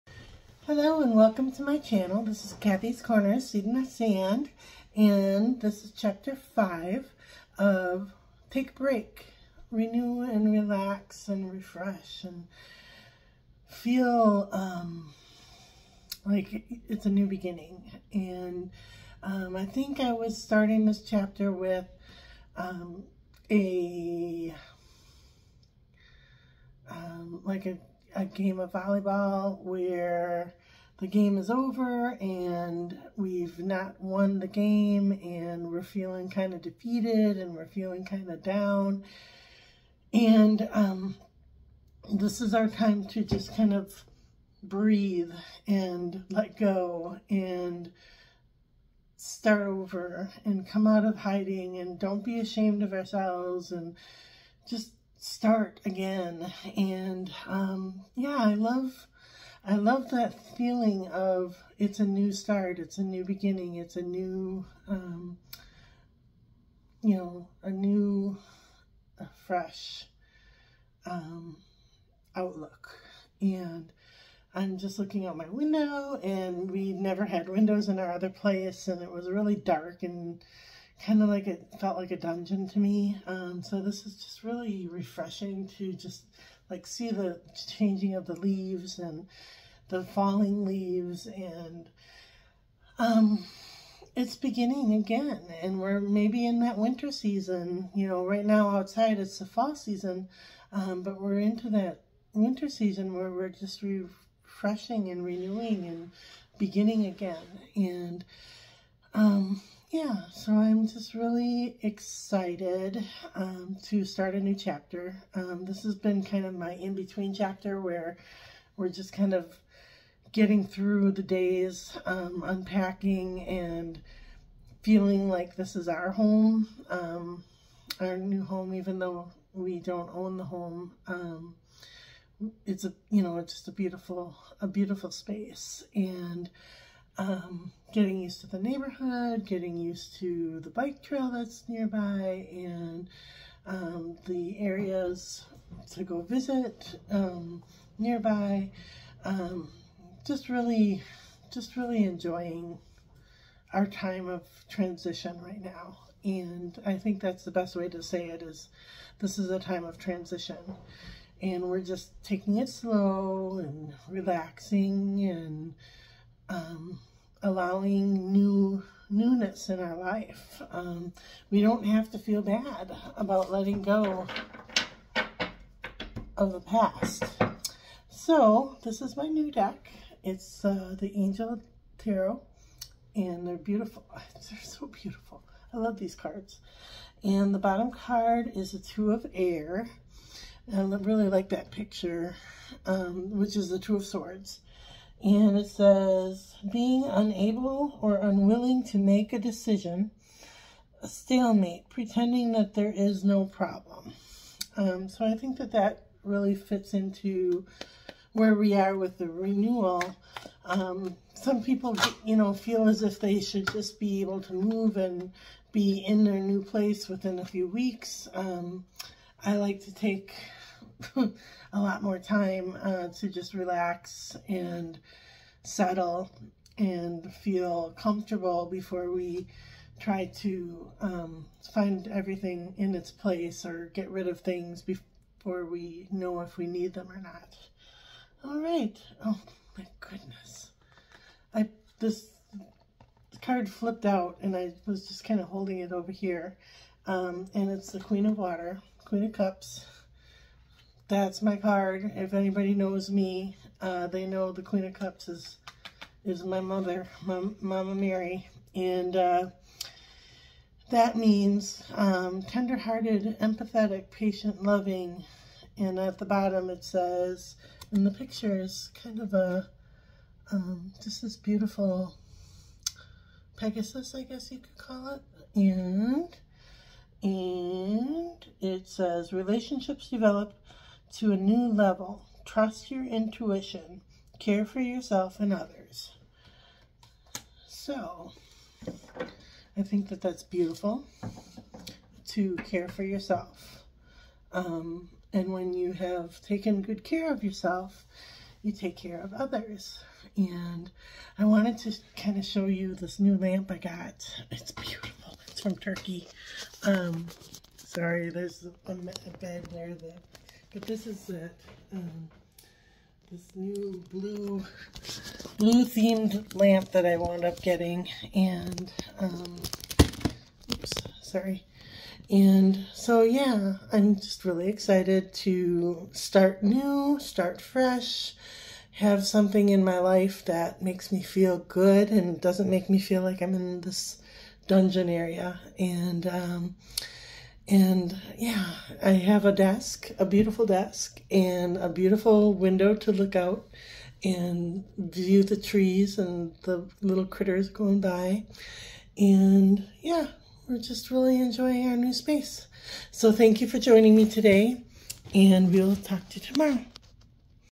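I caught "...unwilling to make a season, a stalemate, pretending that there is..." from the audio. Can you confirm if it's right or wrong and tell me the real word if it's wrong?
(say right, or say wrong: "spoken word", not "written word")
wrong: "decision", not "season".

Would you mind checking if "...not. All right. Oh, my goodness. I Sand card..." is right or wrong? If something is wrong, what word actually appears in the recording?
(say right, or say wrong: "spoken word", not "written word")
wrong: "This", not "Sand".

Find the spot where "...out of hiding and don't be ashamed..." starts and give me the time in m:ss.
0:50.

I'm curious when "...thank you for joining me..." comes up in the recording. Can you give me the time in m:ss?
5:53.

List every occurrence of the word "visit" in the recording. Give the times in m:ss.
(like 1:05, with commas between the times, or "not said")
2:26.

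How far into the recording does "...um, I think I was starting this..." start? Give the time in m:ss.
0:19.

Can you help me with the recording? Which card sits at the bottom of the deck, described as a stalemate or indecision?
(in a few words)
Two of Air.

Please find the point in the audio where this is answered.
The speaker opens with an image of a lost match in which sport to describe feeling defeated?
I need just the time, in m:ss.
0:28.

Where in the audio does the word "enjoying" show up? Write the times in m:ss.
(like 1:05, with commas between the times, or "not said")
2:32, 5:51.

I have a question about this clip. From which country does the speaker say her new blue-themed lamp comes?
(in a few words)
Turkey.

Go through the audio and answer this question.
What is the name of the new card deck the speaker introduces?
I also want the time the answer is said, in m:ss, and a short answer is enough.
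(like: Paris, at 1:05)
Angel Tarot, at 3:01.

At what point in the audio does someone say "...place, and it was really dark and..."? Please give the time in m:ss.
1:18.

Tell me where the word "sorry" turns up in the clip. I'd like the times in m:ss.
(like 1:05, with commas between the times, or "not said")
5:07, 5:21.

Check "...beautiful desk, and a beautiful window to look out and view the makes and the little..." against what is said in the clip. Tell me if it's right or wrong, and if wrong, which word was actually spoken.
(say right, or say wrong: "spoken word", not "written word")
wrong: "trees", not "makes".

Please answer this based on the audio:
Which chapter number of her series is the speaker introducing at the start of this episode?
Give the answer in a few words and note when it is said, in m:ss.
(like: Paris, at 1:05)
5, at 0:05.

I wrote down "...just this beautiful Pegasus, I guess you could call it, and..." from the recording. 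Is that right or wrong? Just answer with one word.
right.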